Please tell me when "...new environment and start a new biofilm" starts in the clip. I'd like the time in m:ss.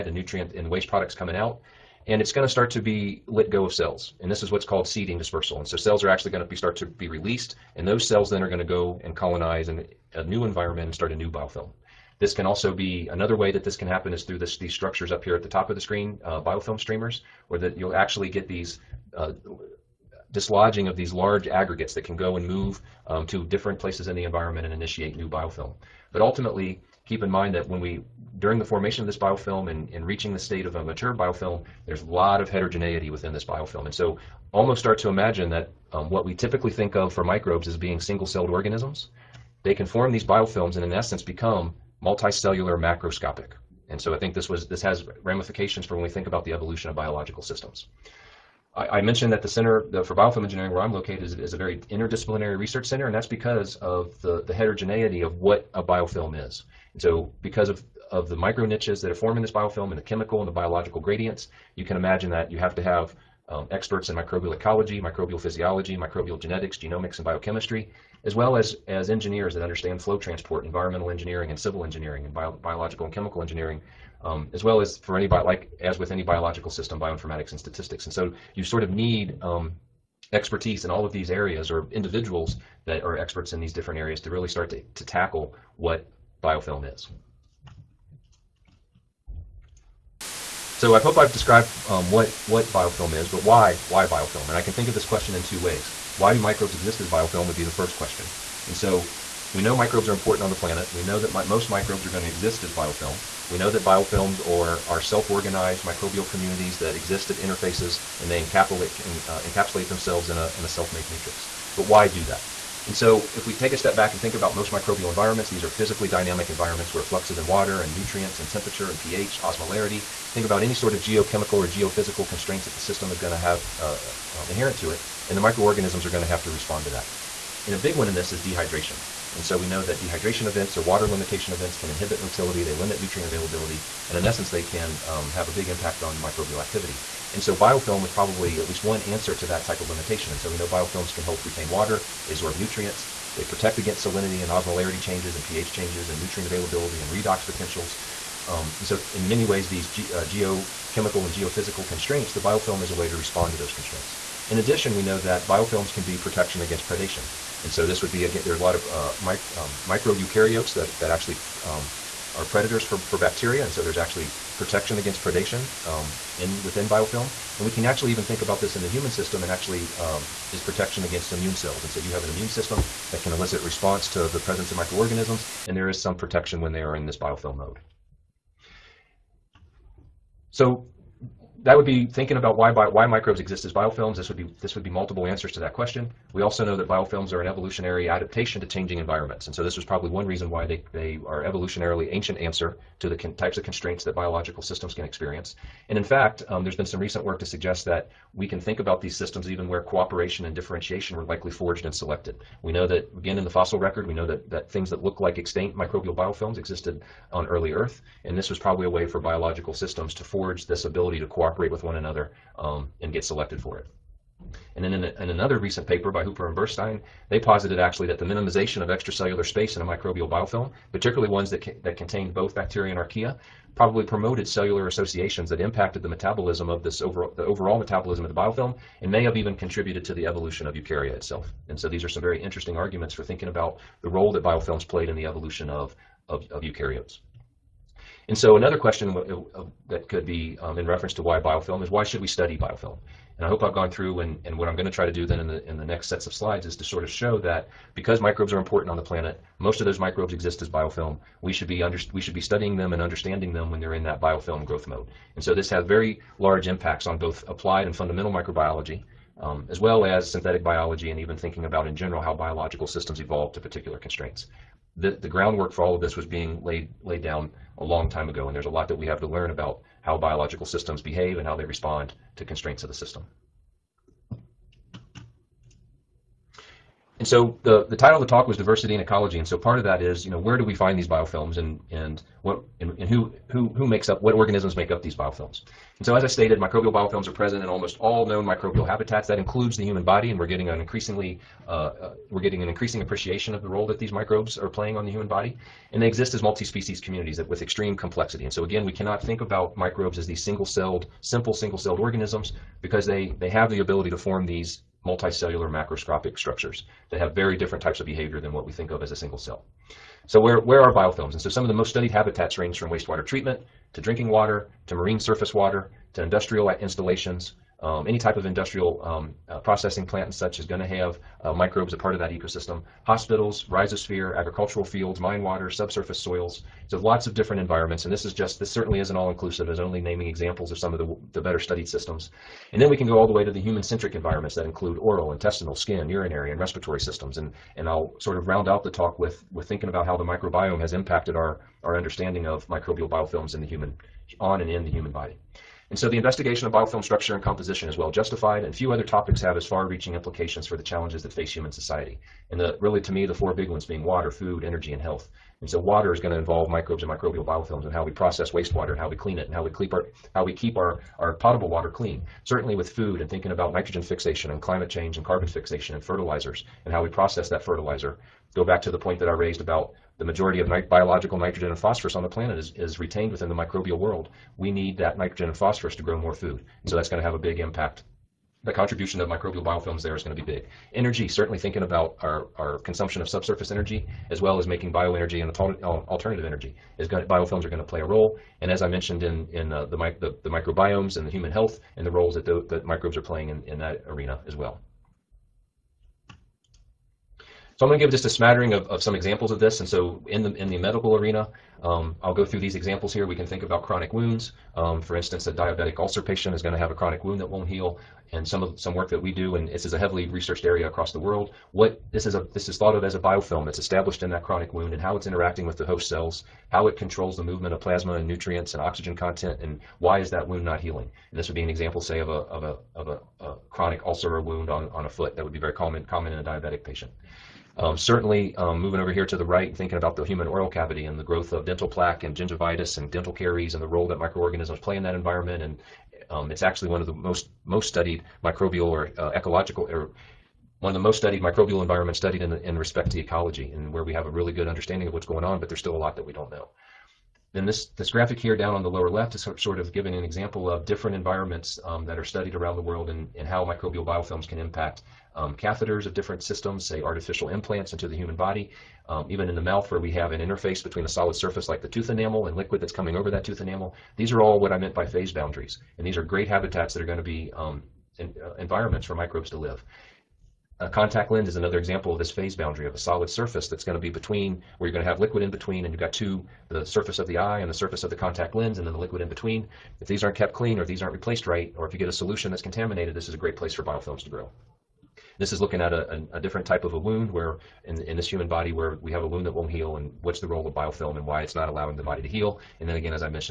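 0:10.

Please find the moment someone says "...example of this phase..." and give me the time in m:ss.
7:51.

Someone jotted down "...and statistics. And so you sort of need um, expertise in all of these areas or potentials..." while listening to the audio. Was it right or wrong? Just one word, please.
wrong.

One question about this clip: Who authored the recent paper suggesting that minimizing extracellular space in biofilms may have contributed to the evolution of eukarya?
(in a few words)
Hooper and Burstein.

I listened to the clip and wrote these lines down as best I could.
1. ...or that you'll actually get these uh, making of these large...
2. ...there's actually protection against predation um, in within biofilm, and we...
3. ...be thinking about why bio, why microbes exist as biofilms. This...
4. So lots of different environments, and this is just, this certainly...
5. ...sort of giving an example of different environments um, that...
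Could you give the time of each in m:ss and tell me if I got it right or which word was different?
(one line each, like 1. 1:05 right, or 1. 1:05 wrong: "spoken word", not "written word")
1. 0:17 wrong: "dislodging", not "making"
2. 2:43 right
3. 3:01 right
4. 5:26 right
5. 7:29 right.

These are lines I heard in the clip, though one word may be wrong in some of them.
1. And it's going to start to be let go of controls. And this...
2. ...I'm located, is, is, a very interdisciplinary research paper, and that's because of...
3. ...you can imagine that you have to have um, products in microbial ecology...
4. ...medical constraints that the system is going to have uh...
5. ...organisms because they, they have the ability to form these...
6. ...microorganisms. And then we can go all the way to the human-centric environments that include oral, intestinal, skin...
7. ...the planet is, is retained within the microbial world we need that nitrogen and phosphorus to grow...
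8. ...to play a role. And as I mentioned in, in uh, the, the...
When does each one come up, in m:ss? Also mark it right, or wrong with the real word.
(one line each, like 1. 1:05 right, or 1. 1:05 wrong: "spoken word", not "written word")
1. 0:02 wrong: "cells", not "controls"
2. 0:50 wrong: "center", not "paper"
3. 1:01 wrong: "experts", not "products"
4. 2:01 wrong: "geophysical", not "medical"
5. 5:01 right
6. 5:31 wrong: "systems", not "microorganisms"
7. 6:12 right
8. 6:27 right.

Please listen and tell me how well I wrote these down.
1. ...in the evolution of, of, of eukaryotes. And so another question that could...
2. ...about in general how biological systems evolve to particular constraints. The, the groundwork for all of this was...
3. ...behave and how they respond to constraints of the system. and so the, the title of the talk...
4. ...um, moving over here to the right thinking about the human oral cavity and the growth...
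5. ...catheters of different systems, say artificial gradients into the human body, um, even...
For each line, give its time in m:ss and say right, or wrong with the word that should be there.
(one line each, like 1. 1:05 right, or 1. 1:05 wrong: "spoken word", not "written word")
1. 3:55 right
2. 4:21 right
3. 4:31 right
4. 7:08 right
5. 7:35 wrong: "implants", not "gradients".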